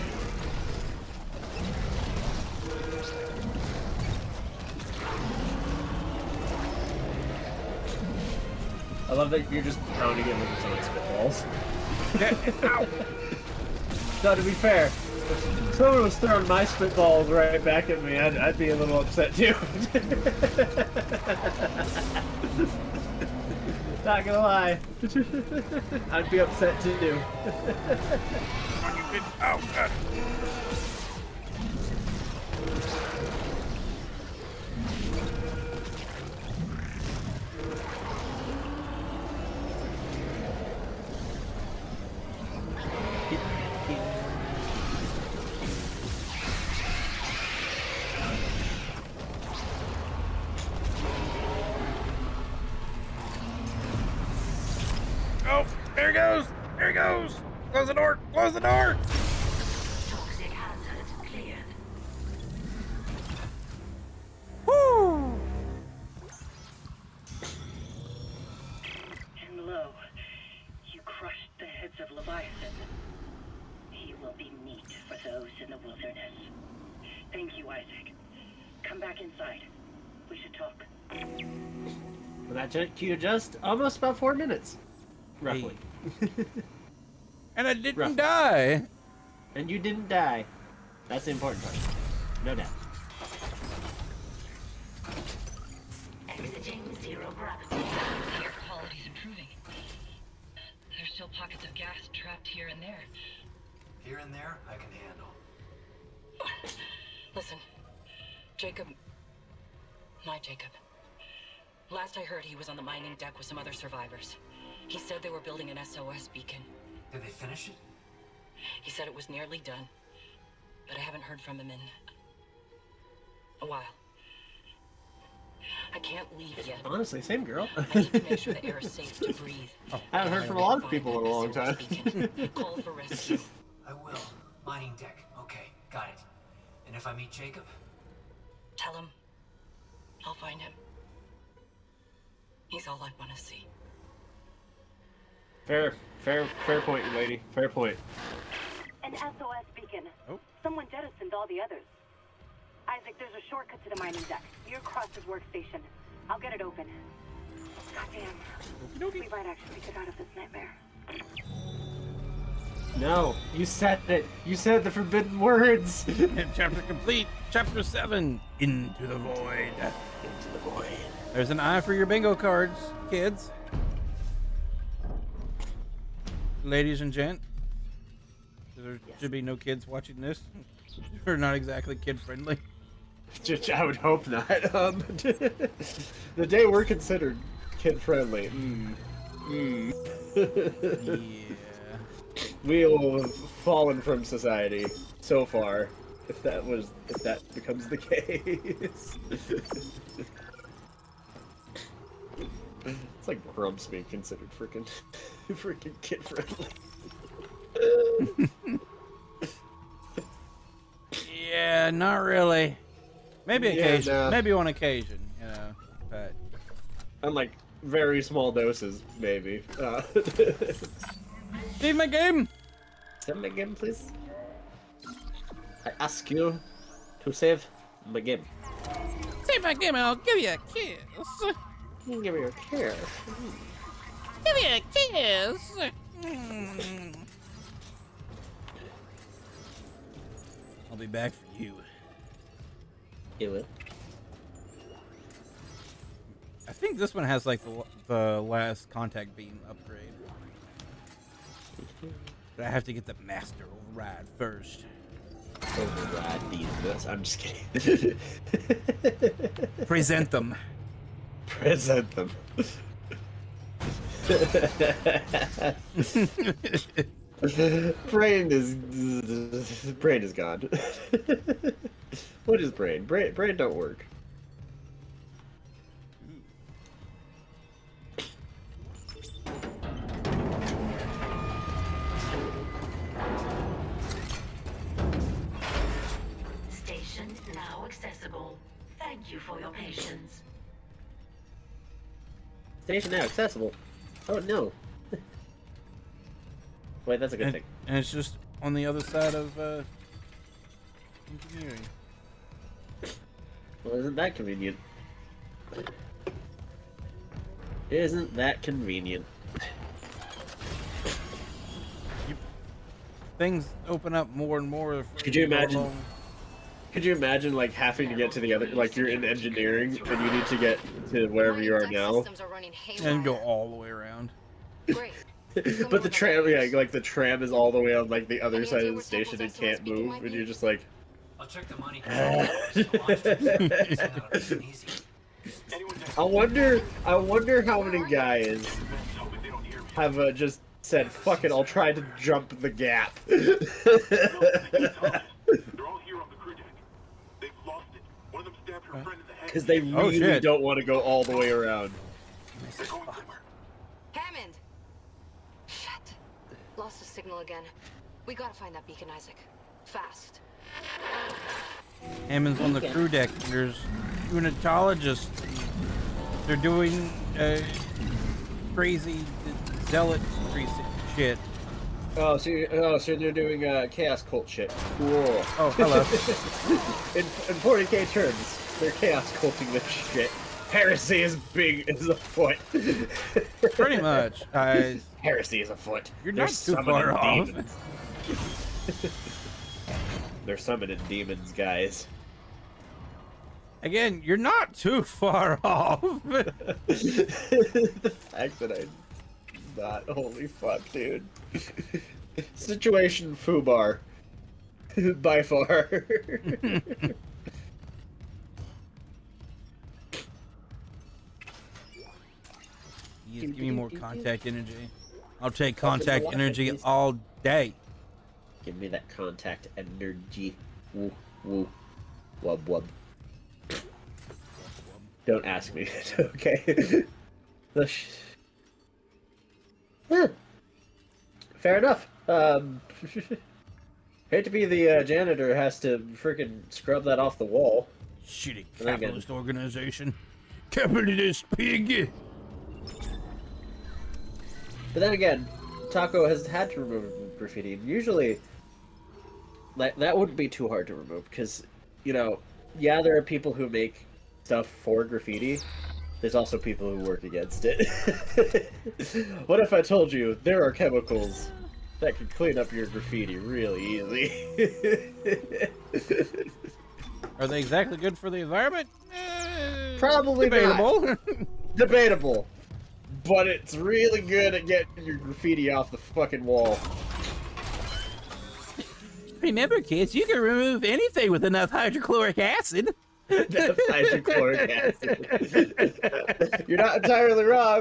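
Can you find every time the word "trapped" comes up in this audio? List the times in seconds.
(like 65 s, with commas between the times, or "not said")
102 s.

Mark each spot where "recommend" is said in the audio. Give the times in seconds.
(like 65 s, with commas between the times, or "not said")
not said.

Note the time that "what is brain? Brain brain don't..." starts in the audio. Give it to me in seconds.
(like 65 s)
272 s.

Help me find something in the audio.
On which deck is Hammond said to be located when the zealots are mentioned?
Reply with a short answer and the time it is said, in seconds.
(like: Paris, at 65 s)
Crew deck, at 362 s.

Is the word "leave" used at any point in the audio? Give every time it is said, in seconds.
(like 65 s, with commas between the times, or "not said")
126 s, 221 s.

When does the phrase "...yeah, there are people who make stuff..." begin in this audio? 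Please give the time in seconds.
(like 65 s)
452 s.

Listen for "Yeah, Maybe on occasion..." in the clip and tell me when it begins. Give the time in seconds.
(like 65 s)
214 s.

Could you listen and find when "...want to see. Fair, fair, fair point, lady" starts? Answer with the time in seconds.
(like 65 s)
143 s.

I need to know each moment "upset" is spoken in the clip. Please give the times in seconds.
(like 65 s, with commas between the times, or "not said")
19 s, 26 s.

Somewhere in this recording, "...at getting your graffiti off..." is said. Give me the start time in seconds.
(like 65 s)
474 s.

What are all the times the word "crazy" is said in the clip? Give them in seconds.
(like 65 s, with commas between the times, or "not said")
368 s.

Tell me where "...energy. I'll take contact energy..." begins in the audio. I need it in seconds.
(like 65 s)
414 s.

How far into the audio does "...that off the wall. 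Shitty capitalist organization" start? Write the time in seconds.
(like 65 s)
437 s.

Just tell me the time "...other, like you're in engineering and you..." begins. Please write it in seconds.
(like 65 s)
318 s.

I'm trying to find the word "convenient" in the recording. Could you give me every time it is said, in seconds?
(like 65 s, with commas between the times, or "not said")
304 s, 308 s.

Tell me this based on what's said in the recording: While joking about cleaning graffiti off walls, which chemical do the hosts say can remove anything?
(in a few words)
Hydrochloric acid.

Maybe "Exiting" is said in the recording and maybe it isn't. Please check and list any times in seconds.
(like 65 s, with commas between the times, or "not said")
96 s.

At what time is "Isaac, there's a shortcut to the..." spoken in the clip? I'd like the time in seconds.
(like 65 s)
152 s.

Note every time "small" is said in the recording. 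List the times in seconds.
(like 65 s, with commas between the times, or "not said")
218 s.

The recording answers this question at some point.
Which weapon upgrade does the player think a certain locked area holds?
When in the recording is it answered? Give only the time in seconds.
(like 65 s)
248 s.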